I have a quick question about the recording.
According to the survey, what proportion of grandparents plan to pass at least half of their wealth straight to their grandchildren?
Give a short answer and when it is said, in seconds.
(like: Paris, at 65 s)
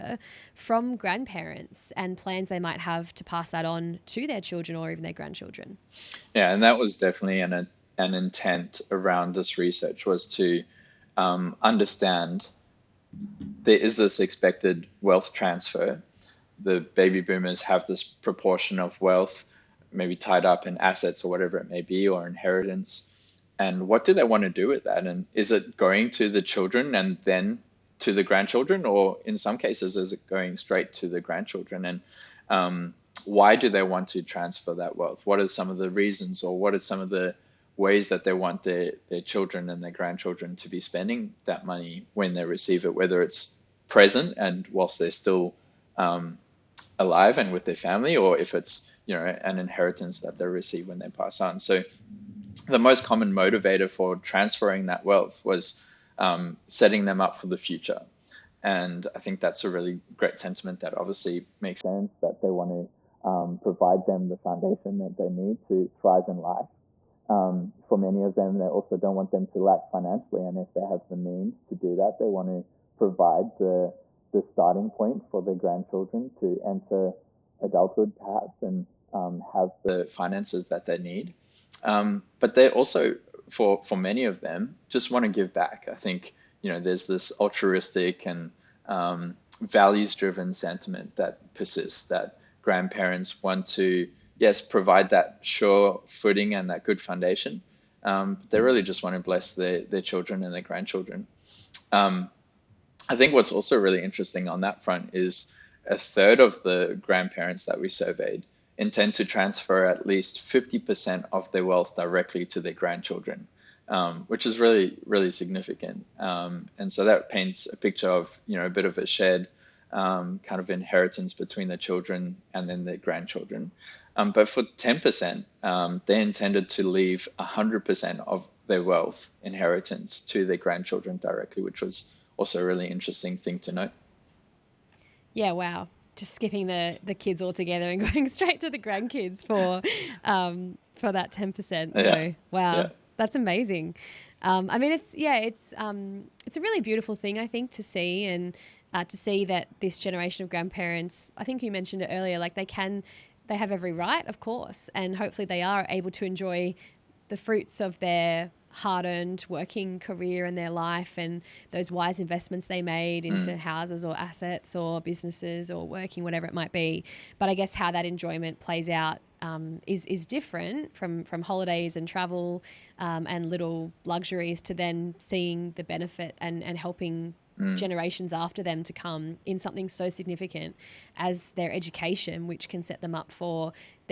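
a third, at 105 s.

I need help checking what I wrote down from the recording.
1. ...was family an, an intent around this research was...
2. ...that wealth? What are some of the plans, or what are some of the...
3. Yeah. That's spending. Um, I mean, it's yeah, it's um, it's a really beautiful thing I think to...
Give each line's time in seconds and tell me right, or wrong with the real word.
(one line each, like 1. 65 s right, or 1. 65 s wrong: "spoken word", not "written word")
1. 6 s wrong: "definitely", not "family"
2. 34 s wrong: "reasons", not "plans"
3. 142 s wrong: "amazing", not "spending".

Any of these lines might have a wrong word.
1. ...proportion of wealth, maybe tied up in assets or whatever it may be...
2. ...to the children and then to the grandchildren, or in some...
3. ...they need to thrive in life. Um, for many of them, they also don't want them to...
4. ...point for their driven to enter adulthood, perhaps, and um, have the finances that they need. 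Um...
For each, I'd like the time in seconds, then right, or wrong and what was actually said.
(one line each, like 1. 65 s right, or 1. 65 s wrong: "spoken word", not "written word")
1. 18 s right
2. 26 s right
3. 65 s right
4. 74 s wrong: "grandchildren", not "driven".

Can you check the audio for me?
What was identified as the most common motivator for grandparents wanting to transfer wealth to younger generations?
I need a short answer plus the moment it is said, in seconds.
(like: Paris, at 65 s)
setting them up for the future, at 56 s.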